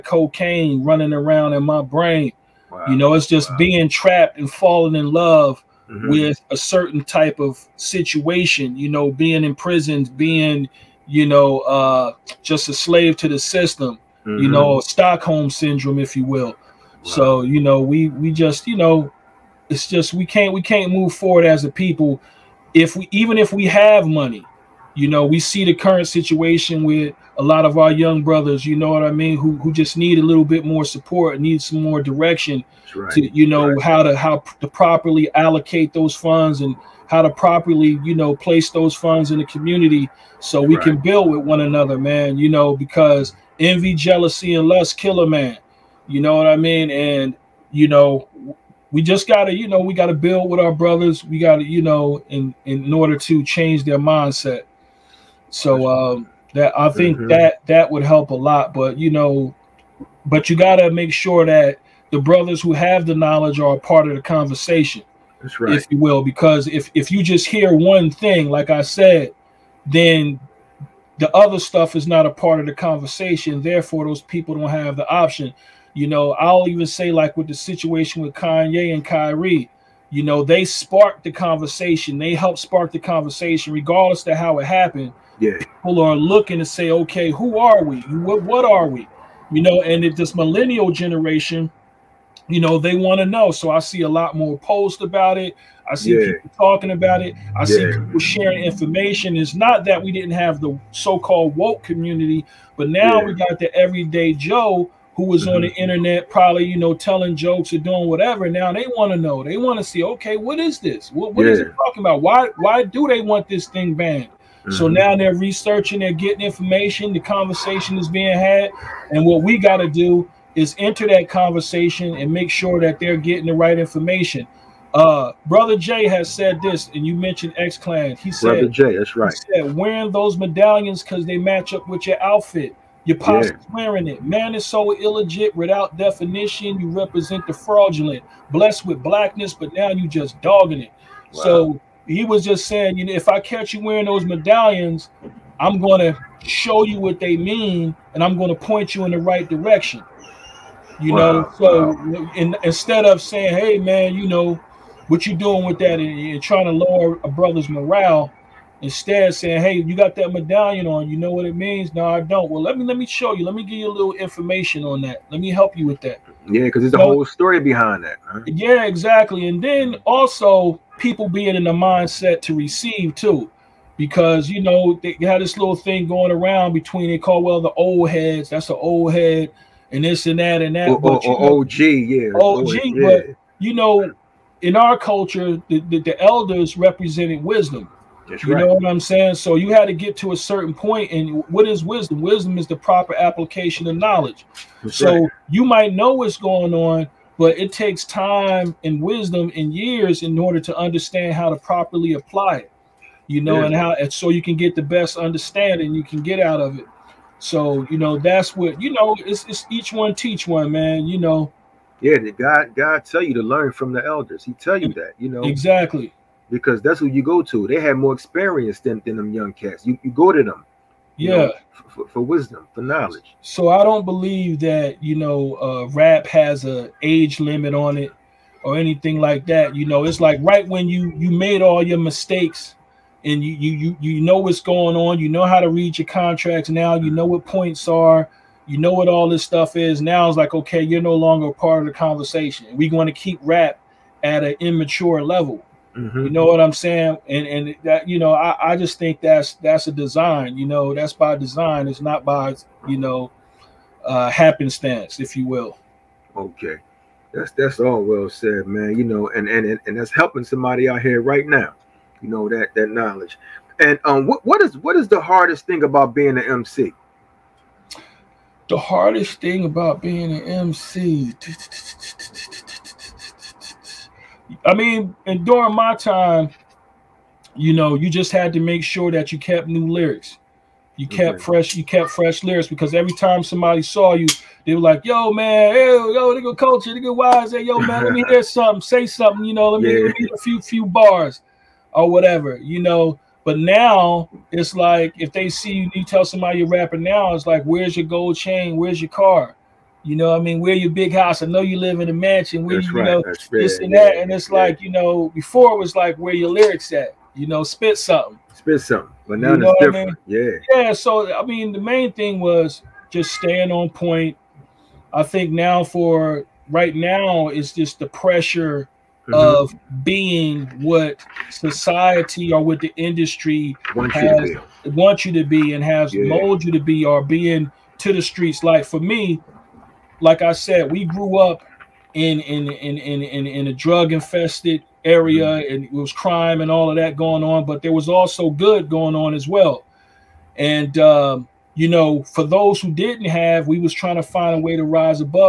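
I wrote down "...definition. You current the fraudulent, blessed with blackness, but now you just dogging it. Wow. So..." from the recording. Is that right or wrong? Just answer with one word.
wrong.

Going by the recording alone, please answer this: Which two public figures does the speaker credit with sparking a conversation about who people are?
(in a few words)
Kanye and Kyrie.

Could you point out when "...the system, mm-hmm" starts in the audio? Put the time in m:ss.
0:13.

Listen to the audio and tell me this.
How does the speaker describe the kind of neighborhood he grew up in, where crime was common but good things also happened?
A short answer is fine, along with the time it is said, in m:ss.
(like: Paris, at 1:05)
Drug infested area, at 5:33.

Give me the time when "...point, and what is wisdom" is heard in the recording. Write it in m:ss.
3:10.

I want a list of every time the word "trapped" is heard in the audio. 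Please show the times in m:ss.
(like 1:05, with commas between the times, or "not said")
0:03.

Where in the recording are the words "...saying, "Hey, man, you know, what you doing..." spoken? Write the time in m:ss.
2:33.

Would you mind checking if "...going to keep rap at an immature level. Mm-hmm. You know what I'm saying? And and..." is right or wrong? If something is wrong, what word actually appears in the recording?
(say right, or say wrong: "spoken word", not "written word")
right.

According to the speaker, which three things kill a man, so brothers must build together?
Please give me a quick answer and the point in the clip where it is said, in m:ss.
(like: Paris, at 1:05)
Envy, jealousy, and lust, at 0:43.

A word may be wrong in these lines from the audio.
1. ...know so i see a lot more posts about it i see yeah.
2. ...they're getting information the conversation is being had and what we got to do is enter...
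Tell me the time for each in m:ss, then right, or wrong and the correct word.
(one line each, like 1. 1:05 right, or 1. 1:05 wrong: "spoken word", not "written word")
1. 1:33 right
2. 1:55 right.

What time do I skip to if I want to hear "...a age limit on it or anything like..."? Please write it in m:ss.
3:46.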